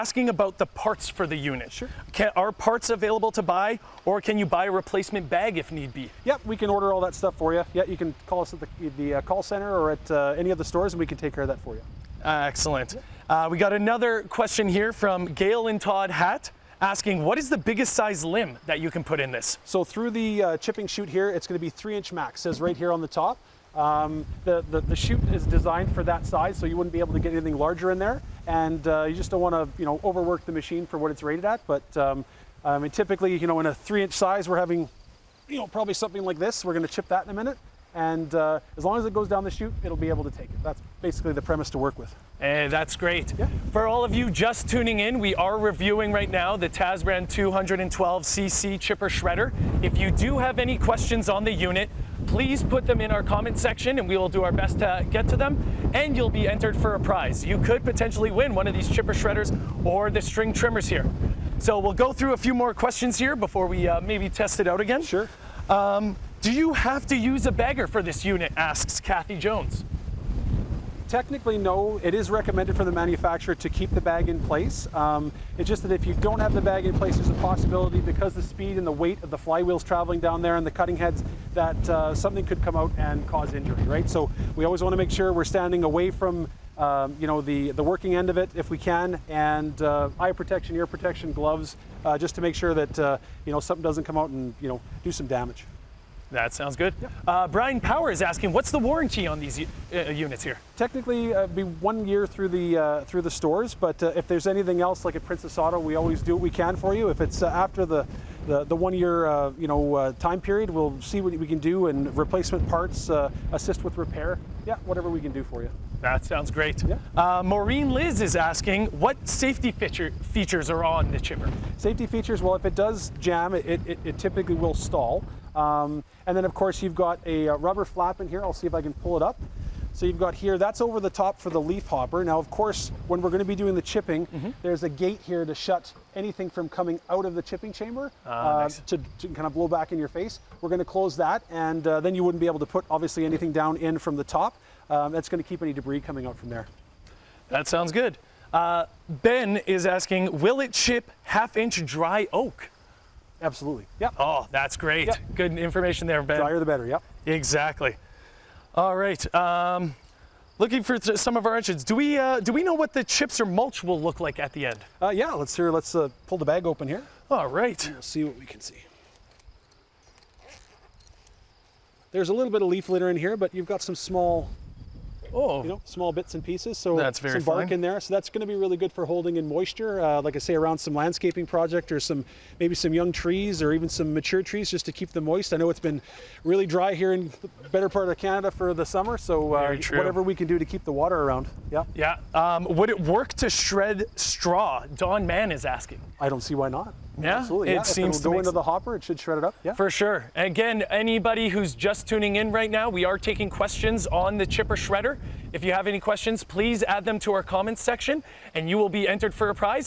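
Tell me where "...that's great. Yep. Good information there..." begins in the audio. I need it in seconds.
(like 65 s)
154 s.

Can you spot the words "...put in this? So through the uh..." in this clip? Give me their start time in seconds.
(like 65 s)
19 s.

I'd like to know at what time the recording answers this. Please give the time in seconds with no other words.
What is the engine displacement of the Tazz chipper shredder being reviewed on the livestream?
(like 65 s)
47 s.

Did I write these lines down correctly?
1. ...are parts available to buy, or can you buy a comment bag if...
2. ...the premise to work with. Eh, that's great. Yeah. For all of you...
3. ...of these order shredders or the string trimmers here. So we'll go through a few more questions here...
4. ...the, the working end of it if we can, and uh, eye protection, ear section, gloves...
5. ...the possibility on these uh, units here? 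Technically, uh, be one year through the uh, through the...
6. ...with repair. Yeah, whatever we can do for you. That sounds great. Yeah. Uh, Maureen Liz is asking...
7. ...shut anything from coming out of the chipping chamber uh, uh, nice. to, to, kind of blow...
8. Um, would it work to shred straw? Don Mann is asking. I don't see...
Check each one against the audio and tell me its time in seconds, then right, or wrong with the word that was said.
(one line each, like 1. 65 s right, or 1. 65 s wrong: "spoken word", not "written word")
1. 2 s wrong: "replacement", not "comment"
2. 41 s right
3. 58 s wrong: "chipper", not "order"
4. 87 s wrong: "protection", not "section"
5. 98 s wrong: "warranty", not "possibility"
6. 113 s right
7. 135 s right
8. 192 s right.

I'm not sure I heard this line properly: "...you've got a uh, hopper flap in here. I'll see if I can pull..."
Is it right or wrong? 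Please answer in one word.
wrong.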